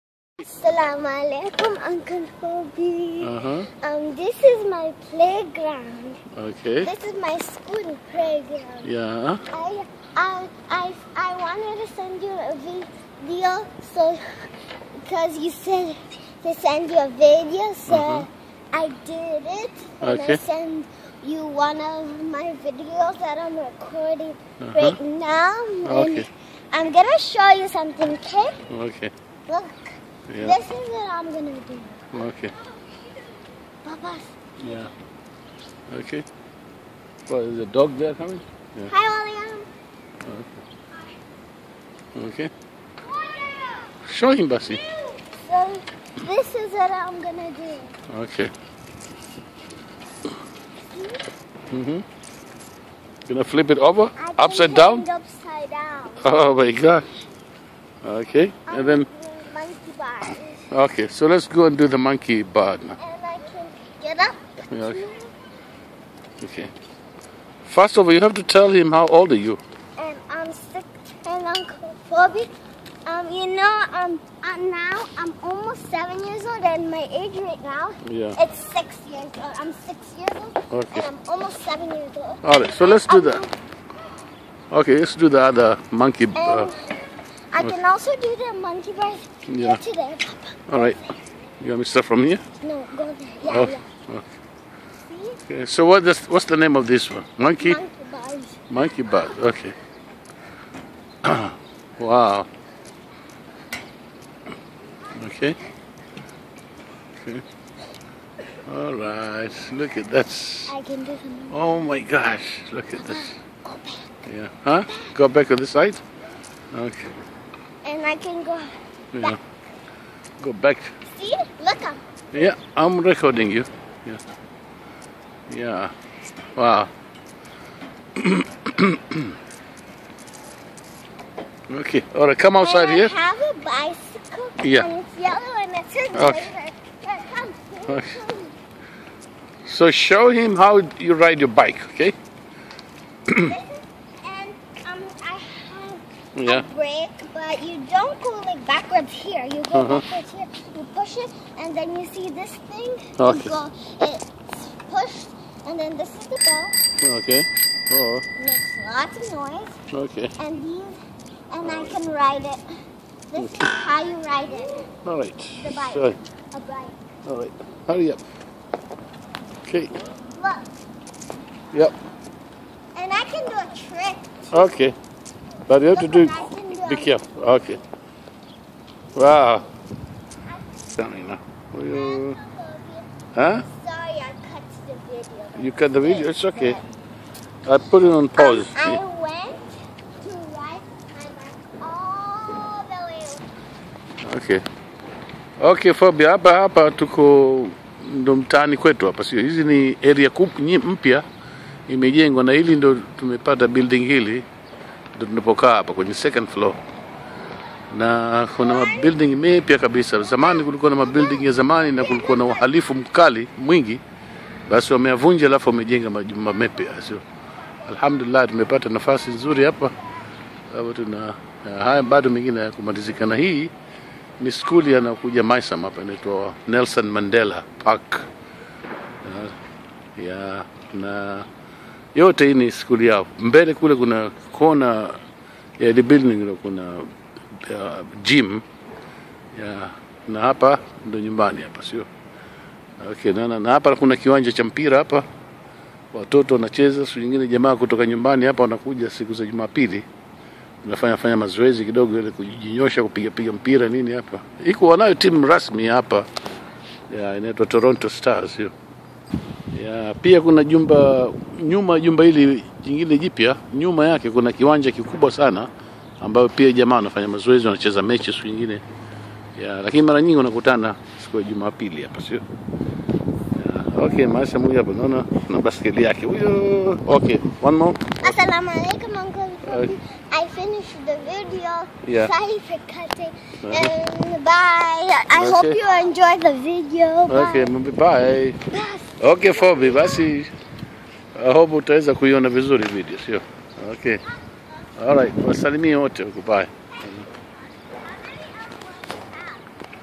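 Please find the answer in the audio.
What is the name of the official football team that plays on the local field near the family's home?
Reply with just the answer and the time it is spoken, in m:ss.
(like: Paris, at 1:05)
Toronto Stars, at 4:17.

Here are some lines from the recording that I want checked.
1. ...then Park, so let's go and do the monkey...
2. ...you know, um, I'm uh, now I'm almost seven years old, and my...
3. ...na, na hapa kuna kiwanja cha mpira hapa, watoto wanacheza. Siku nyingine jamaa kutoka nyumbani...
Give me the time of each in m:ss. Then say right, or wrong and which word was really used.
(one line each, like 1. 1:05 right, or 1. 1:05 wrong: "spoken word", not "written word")
1. 0:58 wrong: "Okay", not "Park"
2. 1:13 right
3. 4:03 right.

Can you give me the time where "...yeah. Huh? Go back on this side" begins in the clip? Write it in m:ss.
1:54.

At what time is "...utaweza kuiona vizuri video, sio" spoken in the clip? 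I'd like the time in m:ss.
4:51.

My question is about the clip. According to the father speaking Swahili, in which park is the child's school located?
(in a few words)
Nelson Mandela Park.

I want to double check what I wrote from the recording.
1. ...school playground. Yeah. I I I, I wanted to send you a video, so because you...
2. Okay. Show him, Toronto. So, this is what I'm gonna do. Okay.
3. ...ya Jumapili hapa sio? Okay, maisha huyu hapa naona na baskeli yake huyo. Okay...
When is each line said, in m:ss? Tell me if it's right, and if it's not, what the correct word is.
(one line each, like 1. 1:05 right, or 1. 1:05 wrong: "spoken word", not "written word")
1. 0:07 right
2. 0:42 wrong: "Bassi", not "Toronto"
3. 4:31 right.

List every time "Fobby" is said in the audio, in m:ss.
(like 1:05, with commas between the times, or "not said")
0:02, 1:12.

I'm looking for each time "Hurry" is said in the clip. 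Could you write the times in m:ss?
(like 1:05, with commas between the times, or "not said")
2:47.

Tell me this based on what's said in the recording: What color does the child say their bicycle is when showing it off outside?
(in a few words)
Yellow.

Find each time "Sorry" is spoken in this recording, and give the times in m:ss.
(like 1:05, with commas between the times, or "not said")
3:03, 4:42.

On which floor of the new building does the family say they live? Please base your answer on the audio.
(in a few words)
Second floor.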